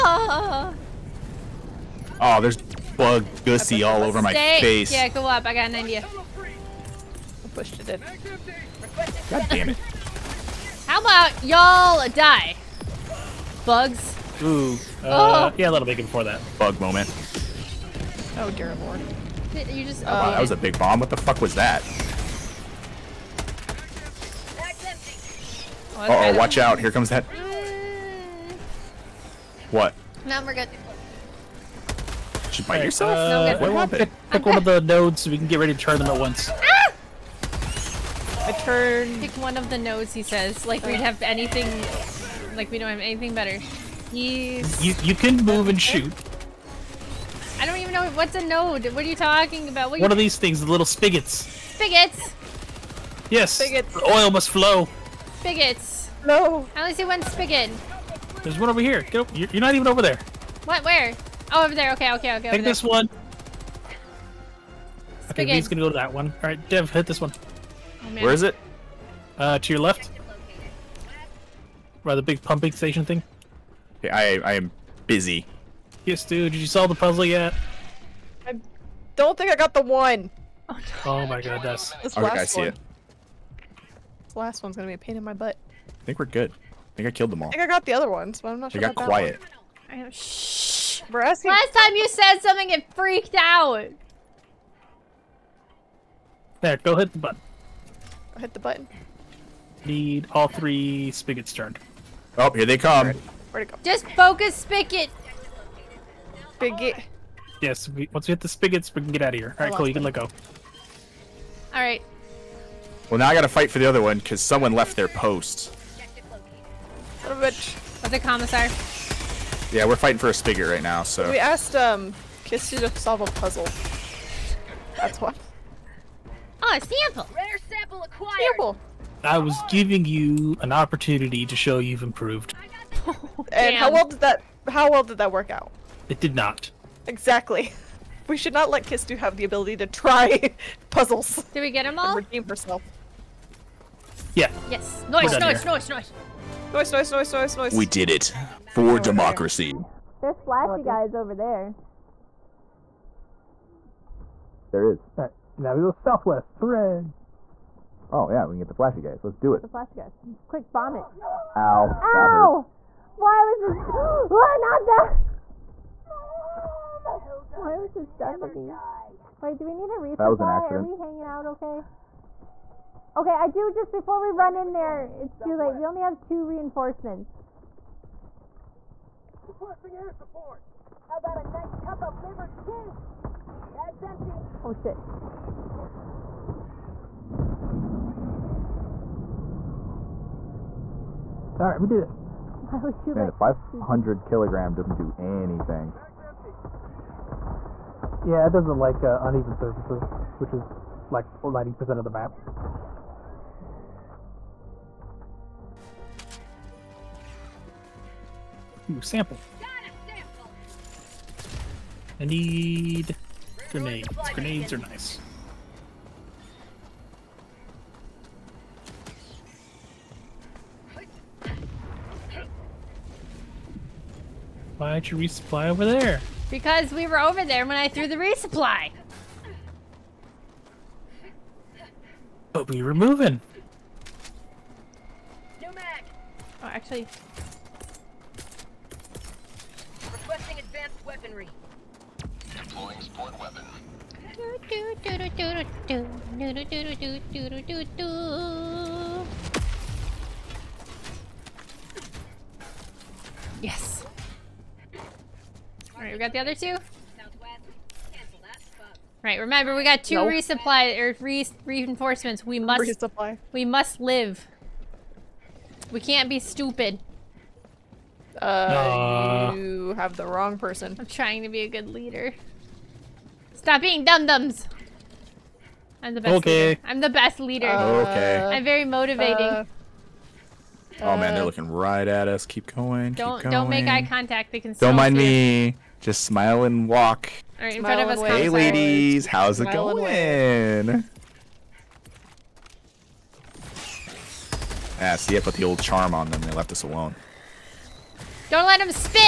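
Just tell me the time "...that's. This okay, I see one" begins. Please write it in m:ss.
1:21.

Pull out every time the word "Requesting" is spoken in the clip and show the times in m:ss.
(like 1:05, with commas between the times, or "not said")
2:59, 4:00.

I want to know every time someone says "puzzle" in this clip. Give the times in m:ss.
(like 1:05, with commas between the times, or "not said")
1:16, 2:03, 2:20.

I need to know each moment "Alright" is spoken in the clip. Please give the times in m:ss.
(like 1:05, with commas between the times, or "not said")
2:35, 4:16.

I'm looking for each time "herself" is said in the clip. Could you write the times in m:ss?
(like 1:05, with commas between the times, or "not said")
2:22.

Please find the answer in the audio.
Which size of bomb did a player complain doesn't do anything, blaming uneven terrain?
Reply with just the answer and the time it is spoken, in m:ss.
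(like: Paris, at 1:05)
500 kilogram, at 3:13.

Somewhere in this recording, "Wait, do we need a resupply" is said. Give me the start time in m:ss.
2:49.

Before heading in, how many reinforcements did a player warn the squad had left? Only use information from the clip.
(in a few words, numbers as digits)
2.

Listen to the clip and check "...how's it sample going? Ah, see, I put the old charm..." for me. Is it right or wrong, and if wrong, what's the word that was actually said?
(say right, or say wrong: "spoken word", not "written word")
wrong: "smile", not "sample".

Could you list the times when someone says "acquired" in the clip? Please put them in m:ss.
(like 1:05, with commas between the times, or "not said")
2:08.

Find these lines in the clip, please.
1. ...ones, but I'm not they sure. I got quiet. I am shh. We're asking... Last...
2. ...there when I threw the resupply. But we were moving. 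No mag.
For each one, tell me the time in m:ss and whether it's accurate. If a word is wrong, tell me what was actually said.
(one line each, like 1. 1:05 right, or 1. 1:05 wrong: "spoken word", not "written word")
1. 1:28 right
2. 3:47 right.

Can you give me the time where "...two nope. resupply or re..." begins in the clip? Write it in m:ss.
4:20.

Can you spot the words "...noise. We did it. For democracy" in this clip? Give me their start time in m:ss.
2:27.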